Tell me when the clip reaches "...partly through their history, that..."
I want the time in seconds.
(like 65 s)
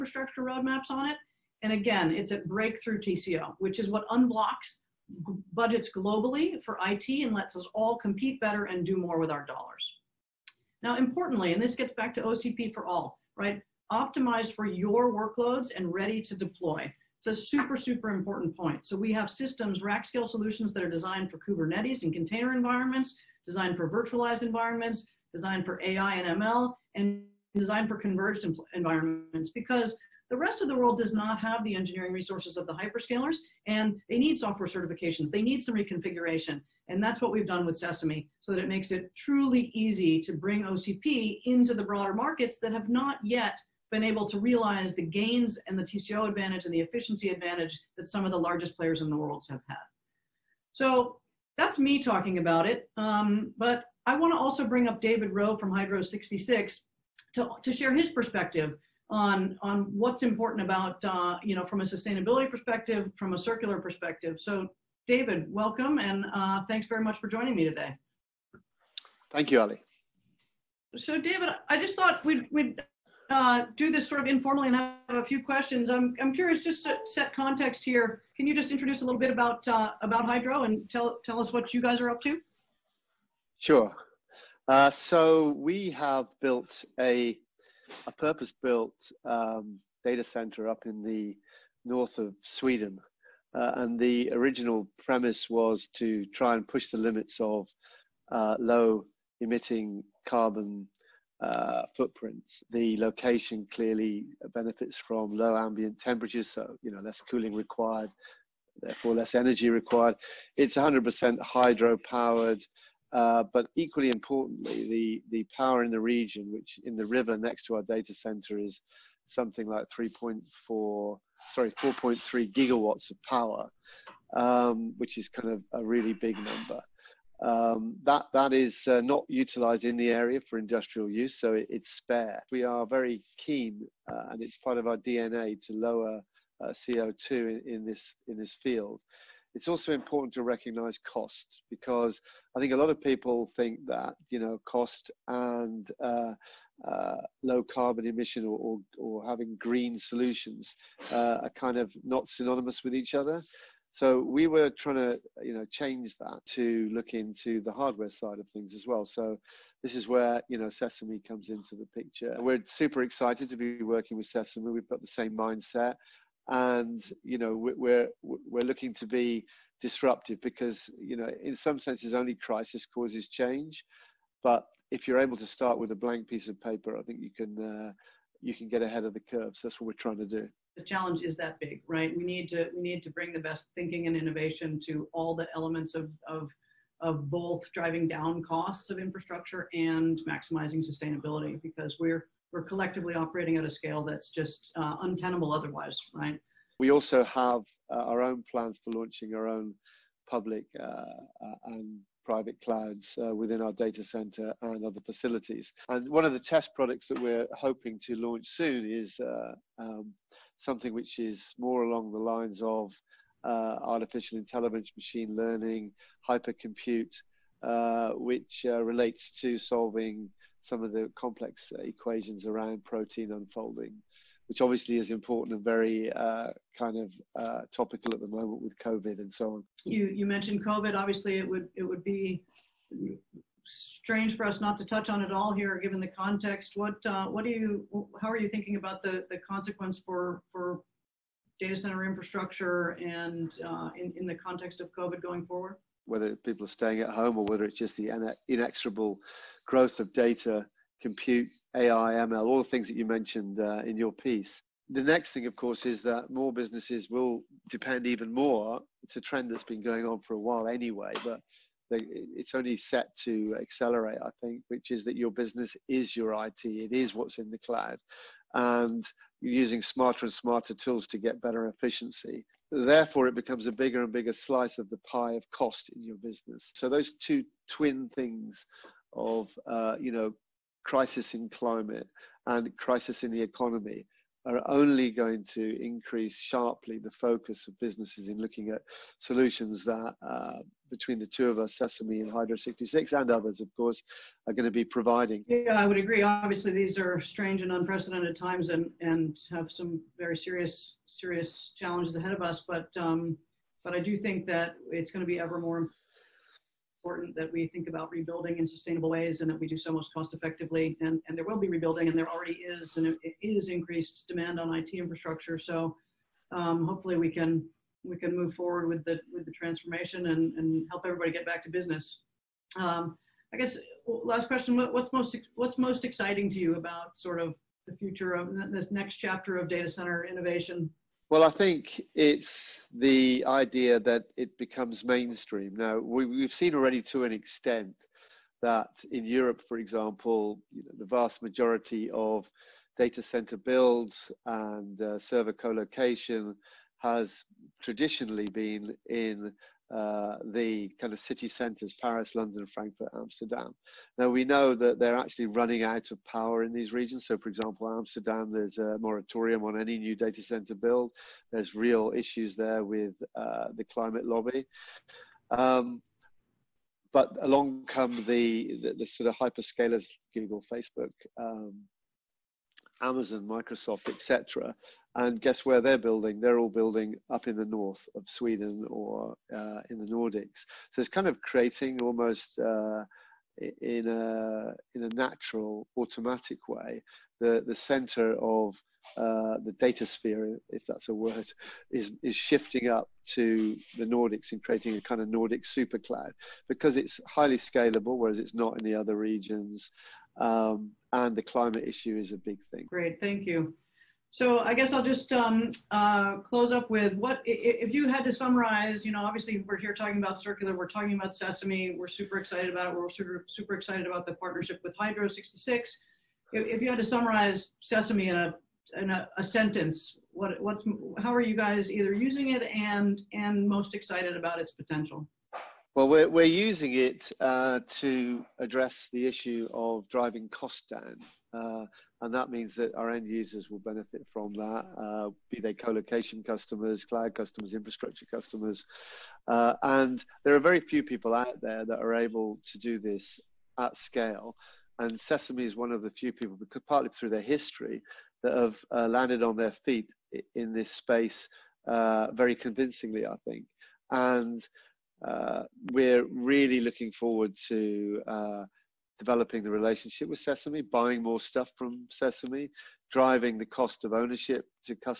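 446 s.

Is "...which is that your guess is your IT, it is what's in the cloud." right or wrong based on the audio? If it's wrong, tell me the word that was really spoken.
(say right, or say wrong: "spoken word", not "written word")
wrong: "business", not "guess".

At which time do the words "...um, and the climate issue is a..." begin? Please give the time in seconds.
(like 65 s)
400 s.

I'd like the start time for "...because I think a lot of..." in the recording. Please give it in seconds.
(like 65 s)
141 s.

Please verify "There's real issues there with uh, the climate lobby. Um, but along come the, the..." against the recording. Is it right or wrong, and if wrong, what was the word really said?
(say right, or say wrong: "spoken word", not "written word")
right.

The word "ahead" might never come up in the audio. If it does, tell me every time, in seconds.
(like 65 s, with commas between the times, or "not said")
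178 s, 302 s.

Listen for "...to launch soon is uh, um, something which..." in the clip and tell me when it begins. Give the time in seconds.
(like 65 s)
208 s.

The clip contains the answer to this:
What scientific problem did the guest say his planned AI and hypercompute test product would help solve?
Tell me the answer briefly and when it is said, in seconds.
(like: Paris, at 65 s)
protein unfolding, at 222 s.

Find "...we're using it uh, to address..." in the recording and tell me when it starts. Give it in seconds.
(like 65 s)
426 s.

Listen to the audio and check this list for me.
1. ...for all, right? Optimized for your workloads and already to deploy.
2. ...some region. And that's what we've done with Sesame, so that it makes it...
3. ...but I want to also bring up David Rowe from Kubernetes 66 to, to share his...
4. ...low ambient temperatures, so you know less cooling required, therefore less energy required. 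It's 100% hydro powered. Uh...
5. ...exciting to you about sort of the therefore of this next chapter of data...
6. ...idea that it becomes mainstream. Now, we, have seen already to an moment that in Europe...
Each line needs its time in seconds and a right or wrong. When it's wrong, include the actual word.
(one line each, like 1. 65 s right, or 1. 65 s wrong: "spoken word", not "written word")
1. 12 s wrong: "ready", not "already"
2. 35 s wrong: "reconfiguration", not "region"
3. 53 s wrong: "Hydro", not "Kubernetes"
4. 105 s right
5. 326 s wrong: "future", not "therefore"
6. 333 s wrong: "extent", not "moment".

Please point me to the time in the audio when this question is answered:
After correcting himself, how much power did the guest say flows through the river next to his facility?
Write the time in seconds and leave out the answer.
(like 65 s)
121 s.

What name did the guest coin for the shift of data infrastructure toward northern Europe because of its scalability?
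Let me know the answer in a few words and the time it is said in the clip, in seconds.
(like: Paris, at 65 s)
Nordic super cloud, at 395 s.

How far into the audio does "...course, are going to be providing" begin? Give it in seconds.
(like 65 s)
293 s.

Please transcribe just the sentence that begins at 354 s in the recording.
Now, we know that they're actually running out of power in these regions.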